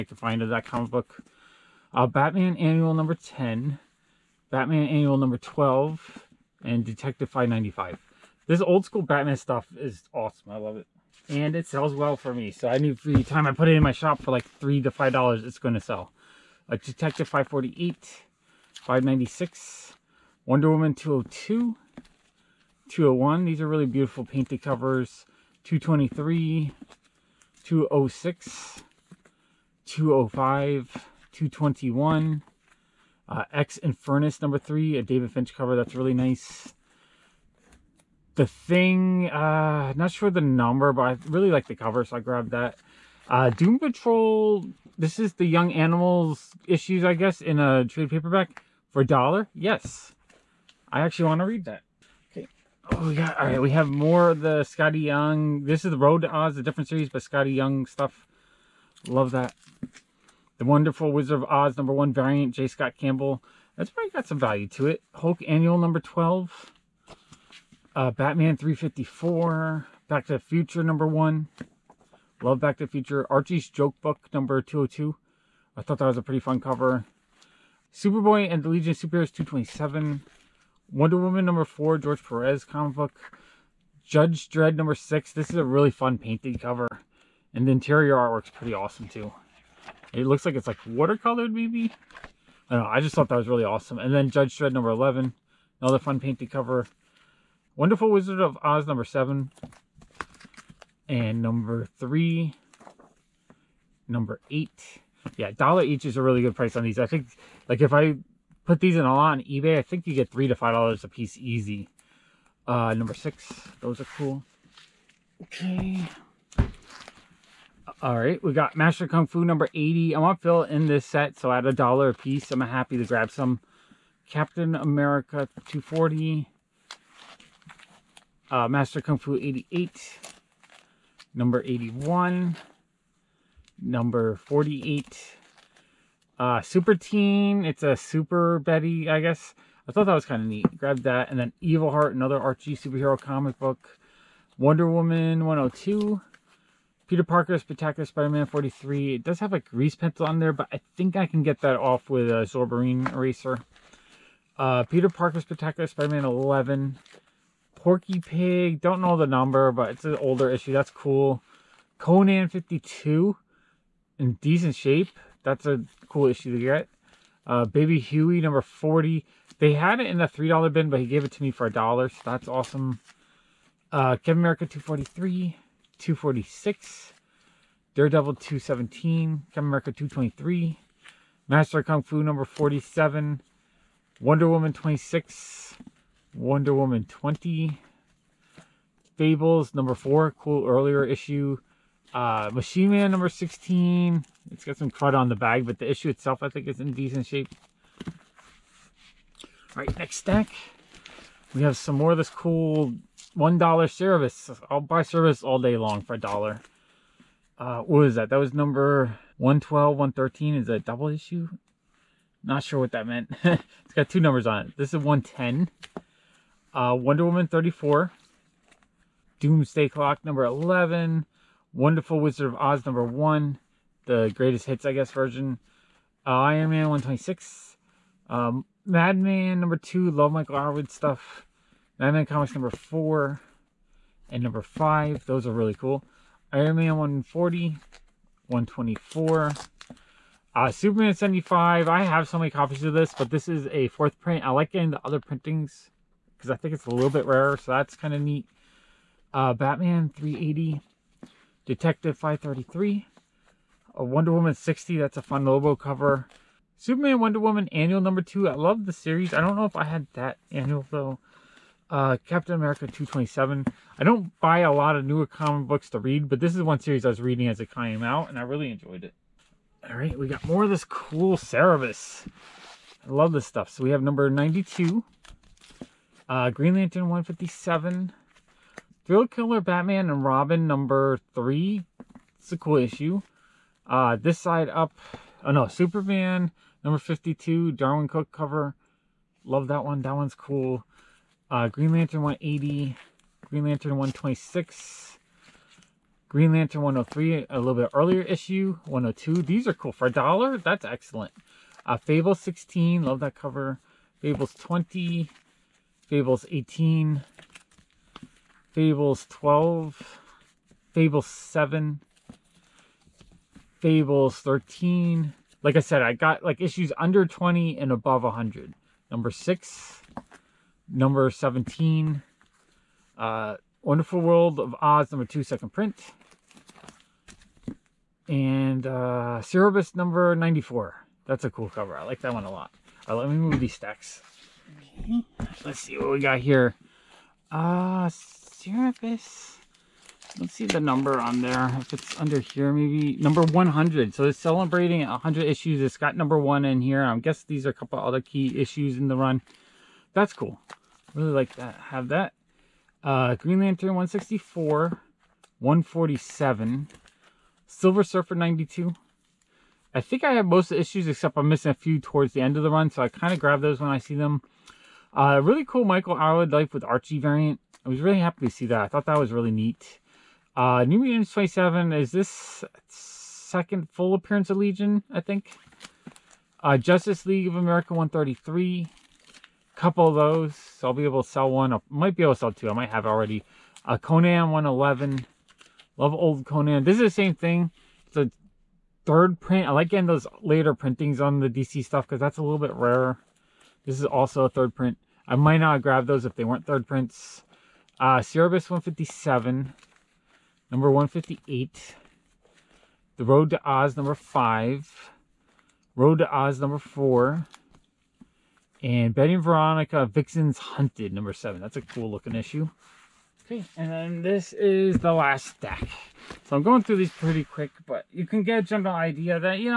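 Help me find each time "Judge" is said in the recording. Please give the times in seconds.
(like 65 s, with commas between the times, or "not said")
84 s, 94 s.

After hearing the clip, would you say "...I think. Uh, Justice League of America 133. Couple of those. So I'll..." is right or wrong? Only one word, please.
right.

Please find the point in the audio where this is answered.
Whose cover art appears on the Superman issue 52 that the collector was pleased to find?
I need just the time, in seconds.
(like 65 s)
287 s.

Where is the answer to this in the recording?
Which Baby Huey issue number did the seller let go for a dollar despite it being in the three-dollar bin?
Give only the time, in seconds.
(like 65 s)
168 s.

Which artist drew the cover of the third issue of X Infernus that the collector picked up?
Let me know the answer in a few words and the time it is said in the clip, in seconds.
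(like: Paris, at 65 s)
David Finch, at 35 s.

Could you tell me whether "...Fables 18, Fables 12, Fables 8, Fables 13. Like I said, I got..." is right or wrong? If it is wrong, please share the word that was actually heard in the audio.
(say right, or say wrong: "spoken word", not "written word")
wrong: "7", not "8".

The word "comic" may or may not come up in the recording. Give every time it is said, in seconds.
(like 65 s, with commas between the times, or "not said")
0 s, 82 s, 143 s, 232 s, 265 s.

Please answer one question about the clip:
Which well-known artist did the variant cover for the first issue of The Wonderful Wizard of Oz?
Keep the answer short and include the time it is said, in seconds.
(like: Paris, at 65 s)
J. Scott Campbell, at 62 s.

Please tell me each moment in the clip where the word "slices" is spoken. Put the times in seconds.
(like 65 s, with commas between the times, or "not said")
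not said.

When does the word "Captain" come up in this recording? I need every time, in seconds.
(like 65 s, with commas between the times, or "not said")
124 s, 174 s, 179 s, 262 s.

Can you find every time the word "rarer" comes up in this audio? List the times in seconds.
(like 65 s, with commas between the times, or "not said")
247 s, 392 s.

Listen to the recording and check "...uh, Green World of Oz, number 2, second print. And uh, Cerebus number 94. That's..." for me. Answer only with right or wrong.
wrong.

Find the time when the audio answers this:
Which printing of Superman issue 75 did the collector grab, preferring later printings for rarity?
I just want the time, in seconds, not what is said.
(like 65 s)
243 s.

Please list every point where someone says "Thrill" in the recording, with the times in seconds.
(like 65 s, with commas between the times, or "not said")
279 s.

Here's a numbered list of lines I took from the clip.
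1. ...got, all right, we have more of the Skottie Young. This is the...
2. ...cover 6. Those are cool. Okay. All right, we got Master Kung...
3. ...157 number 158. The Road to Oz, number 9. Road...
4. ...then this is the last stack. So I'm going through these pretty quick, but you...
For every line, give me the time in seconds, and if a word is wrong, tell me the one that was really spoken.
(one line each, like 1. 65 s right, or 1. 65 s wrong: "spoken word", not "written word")
1. 53 s right
2. 112 s wrong: "number", not "cover"
3. 398 s wrong: "5", not "9"
4. 413 s right.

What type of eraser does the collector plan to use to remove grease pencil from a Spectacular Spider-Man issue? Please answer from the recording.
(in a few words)
Zorbarine eraser.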